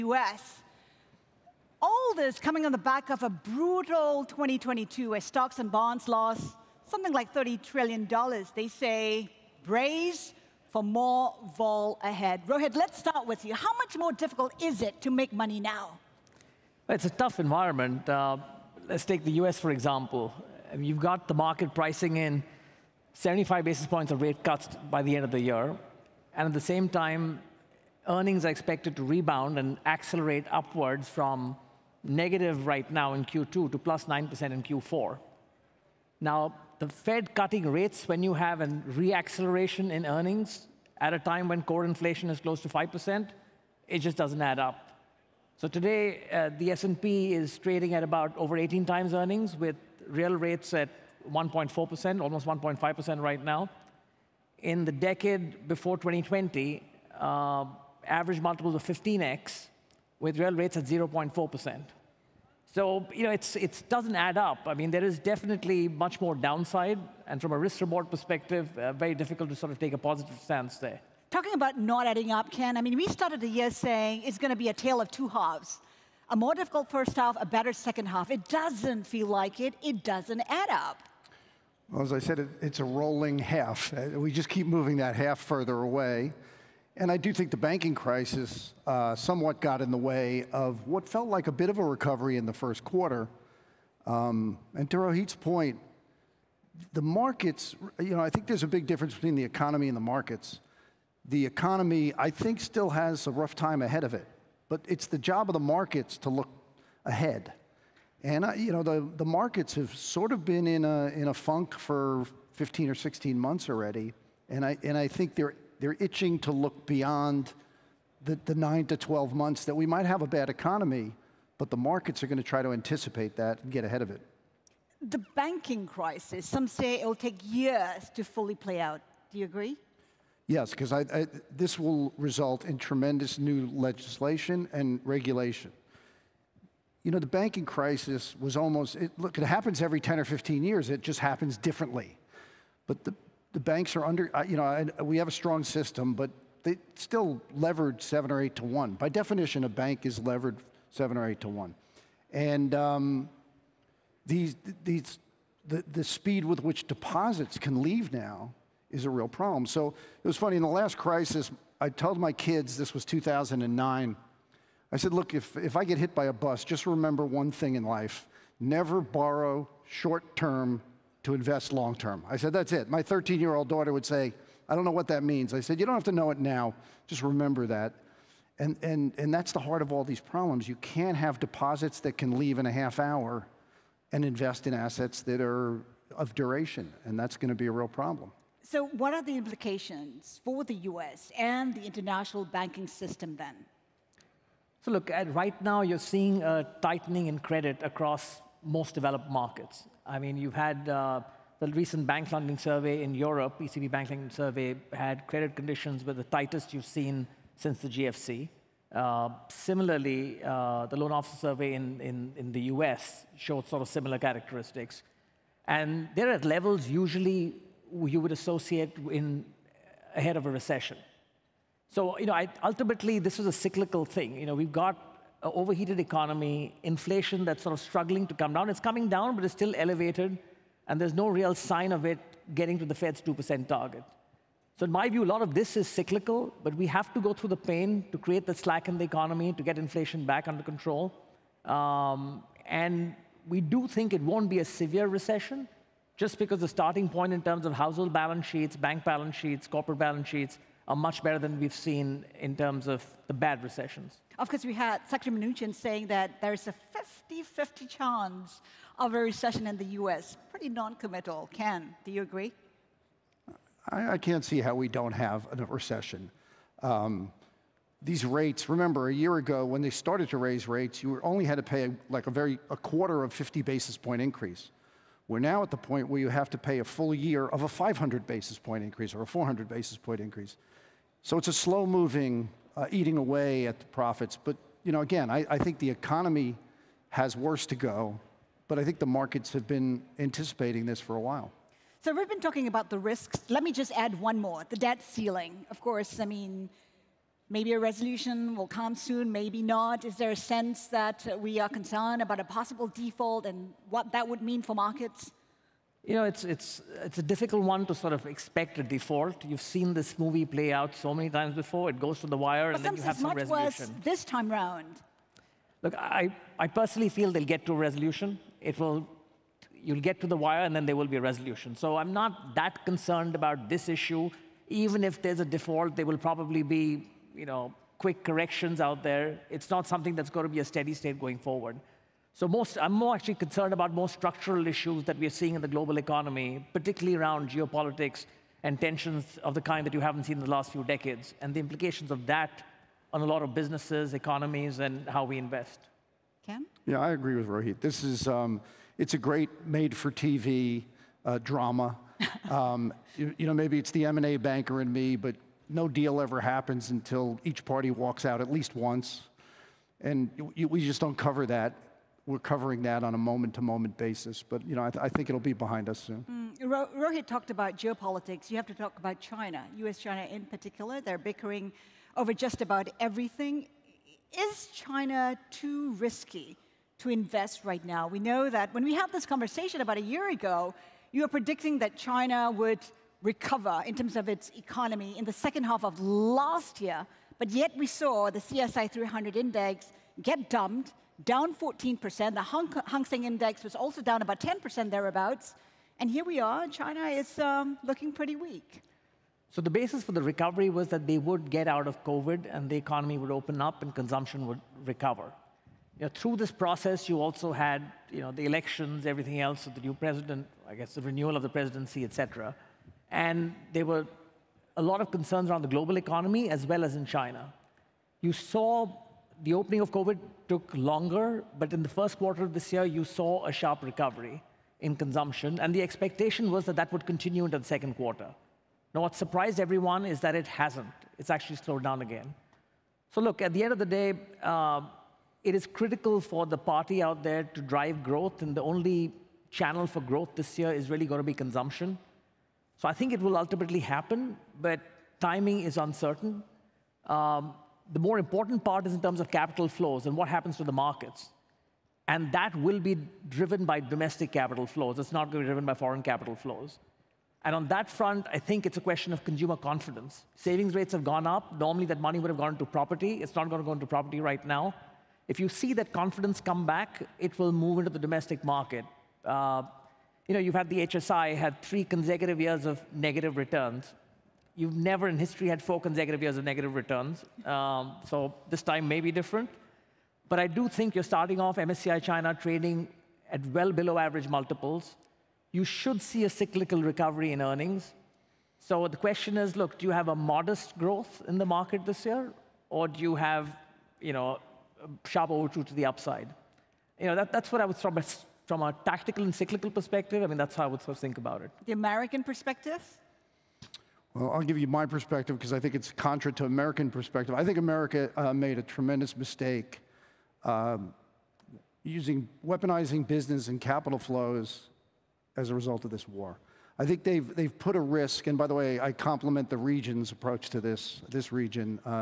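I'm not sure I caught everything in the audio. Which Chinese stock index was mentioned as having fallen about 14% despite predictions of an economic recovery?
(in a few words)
CSI 300.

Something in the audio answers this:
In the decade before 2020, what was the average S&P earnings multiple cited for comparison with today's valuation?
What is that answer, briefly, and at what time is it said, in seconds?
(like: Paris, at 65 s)
15x, at 58 s.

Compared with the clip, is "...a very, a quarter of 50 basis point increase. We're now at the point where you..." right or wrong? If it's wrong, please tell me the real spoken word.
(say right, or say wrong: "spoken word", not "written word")
right.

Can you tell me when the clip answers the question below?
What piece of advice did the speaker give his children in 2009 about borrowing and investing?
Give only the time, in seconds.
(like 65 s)
168 s.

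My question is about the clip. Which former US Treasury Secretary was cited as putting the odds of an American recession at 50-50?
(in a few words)
Mnuchin.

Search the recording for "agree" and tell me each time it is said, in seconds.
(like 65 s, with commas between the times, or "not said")
129 s, 262 s, 347 s.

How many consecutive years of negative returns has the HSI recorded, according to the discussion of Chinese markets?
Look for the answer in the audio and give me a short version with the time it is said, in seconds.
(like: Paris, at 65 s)
3, at 471 s.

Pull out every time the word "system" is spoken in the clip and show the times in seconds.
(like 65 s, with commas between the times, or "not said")
145 s, 192 s.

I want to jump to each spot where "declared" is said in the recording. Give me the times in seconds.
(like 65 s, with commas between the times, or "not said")
not said.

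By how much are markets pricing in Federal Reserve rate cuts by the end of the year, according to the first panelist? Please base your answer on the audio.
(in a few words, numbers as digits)
75 basis points.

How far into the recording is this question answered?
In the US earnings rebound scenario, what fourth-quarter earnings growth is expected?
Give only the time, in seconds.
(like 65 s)
33 s.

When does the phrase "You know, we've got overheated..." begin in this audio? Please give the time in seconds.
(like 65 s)
224 s.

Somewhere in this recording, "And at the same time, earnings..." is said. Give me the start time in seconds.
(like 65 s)
26 s.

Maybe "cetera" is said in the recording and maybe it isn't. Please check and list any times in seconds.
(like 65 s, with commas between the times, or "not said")
412 s.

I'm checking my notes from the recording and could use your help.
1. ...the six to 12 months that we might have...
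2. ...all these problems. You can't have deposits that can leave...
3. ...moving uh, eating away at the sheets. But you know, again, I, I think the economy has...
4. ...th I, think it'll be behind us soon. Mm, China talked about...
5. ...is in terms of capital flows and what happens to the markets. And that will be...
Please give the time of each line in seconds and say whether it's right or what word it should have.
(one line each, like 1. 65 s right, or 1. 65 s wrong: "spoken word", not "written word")
1. 118 s wrong: "nine", not "six"
2. 179 s right
3. 281 s wrong: "profits", not "sheets"
4. 364 s wrong: "Rohit", not "China"
5. 448 s right.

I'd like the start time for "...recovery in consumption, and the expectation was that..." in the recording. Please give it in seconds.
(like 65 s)
423 s.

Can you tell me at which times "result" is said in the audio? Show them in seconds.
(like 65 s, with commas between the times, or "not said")
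132 s, 515 s.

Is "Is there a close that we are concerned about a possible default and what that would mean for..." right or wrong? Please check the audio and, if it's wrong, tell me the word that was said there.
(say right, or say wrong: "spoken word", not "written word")
wrong: "sense", not "close".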